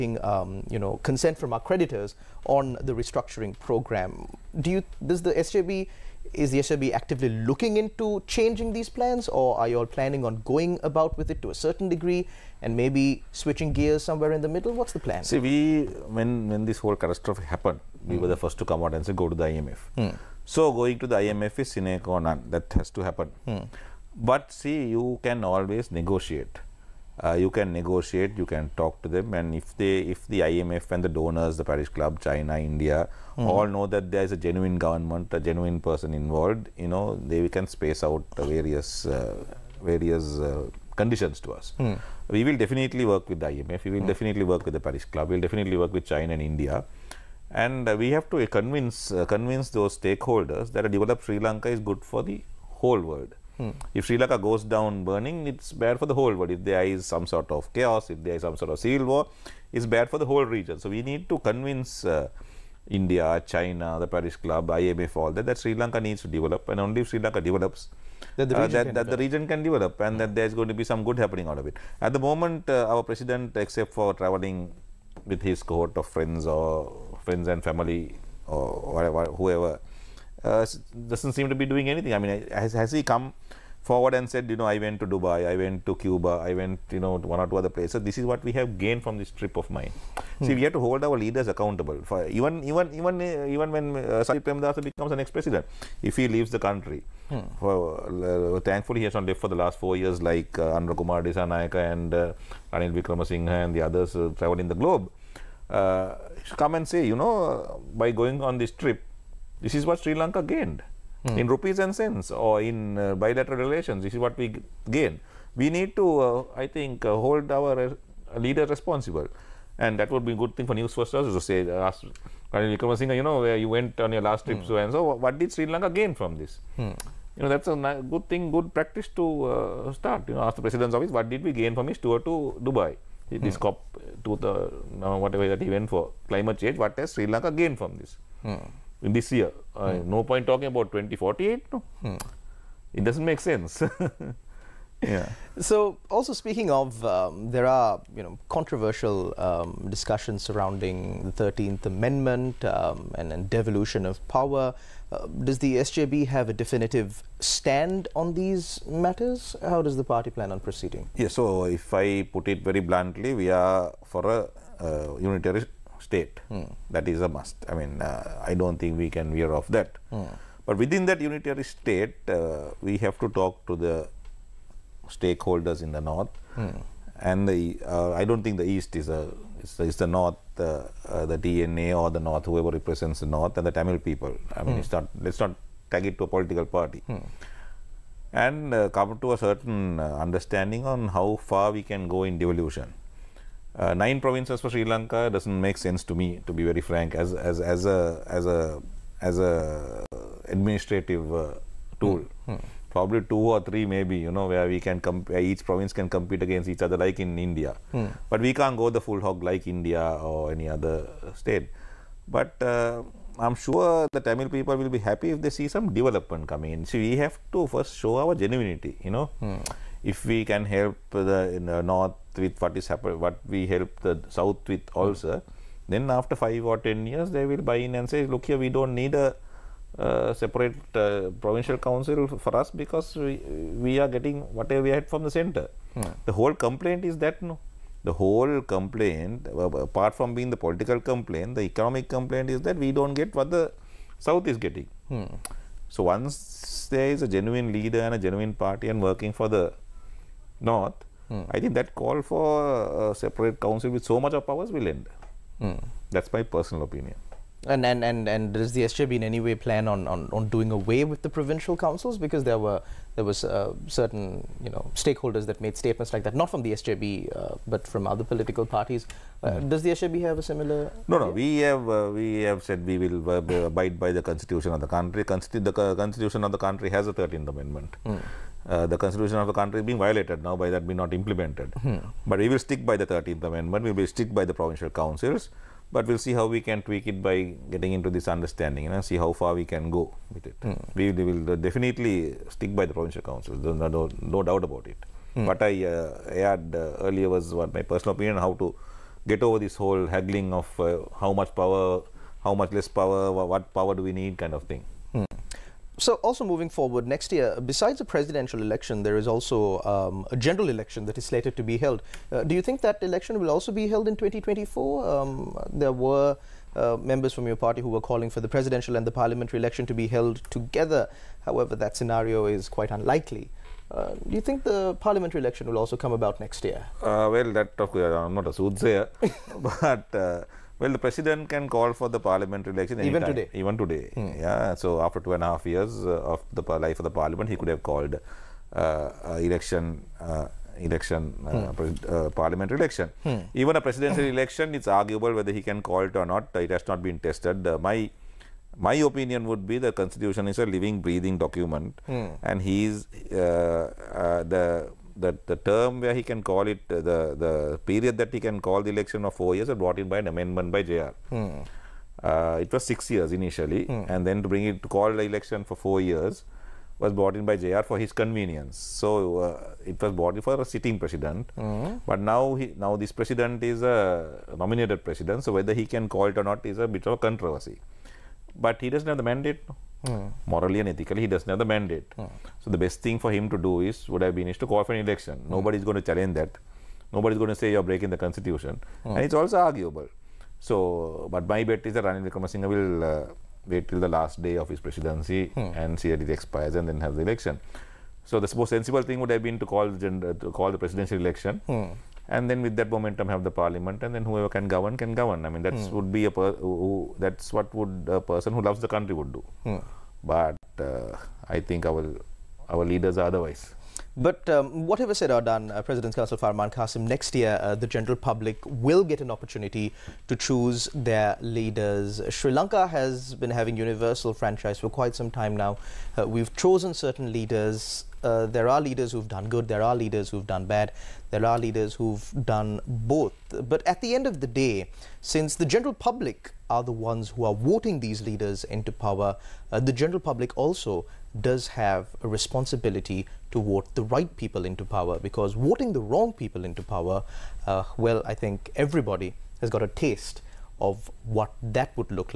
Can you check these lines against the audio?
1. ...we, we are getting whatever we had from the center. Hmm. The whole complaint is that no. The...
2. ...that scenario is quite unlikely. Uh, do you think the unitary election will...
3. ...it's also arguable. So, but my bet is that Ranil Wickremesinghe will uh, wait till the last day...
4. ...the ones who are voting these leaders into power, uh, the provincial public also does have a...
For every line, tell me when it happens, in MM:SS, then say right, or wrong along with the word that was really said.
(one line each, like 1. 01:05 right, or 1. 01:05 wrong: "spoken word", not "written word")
1. 03:53 right
2. 05:21 wrong: "parliamentary", not "unitary"
3. 06:29 right
4. 07:16 wrong: "general", not "provincial".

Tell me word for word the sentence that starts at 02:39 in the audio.
How does the party plan on proceeding?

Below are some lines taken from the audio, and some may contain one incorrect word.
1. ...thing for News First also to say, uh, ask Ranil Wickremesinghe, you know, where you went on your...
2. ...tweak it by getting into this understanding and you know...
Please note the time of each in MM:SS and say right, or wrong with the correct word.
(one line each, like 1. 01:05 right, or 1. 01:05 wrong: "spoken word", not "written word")
1. 02:00 right
2. 04:46 right.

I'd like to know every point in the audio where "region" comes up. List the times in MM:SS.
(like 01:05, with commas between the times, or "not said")
01:00, 01:09.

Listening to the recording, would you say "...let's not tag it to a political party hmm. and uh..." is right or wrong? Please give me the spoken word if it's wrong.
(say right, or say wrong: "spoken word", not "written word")
right.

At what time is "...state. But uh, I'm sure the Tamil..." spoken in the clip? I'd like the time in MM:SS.
03:31.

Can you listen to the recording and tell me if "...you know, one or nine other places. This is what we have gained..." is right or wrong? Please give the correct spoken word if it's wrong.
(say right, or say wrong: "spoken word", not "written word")
wrong: "two", not "nine".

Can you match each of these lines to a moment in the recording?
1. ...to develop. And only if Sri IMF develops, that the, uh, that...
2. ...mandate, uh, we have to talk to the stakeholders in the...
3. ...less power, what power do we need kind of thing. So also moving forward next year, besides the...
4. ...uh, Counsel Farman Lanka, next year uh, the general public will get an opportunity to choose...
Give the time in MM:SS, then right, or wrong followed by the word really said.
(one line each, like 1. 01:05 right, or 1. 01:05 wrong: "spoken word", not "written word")
1. 01:06 wrong: "Lanka", not "IMF"
2. 02:51 wrong: "state", not "mandate"
3. 05:02 right
4. 06:55 wrong: "Cassim", not "Lanka".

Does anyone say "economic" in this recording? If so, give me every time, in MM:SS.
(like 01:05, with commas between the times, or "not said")
04:01.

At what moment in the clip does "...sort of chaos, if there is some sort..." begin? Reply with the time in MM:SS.
00:57.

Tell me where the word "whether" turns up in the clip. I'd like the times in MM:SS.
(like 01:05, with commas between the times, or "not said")
05:45, 06:15.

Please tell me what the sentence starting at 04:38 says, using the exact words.
Mm uh, the constitution of the country is being violated now by that being not implemented.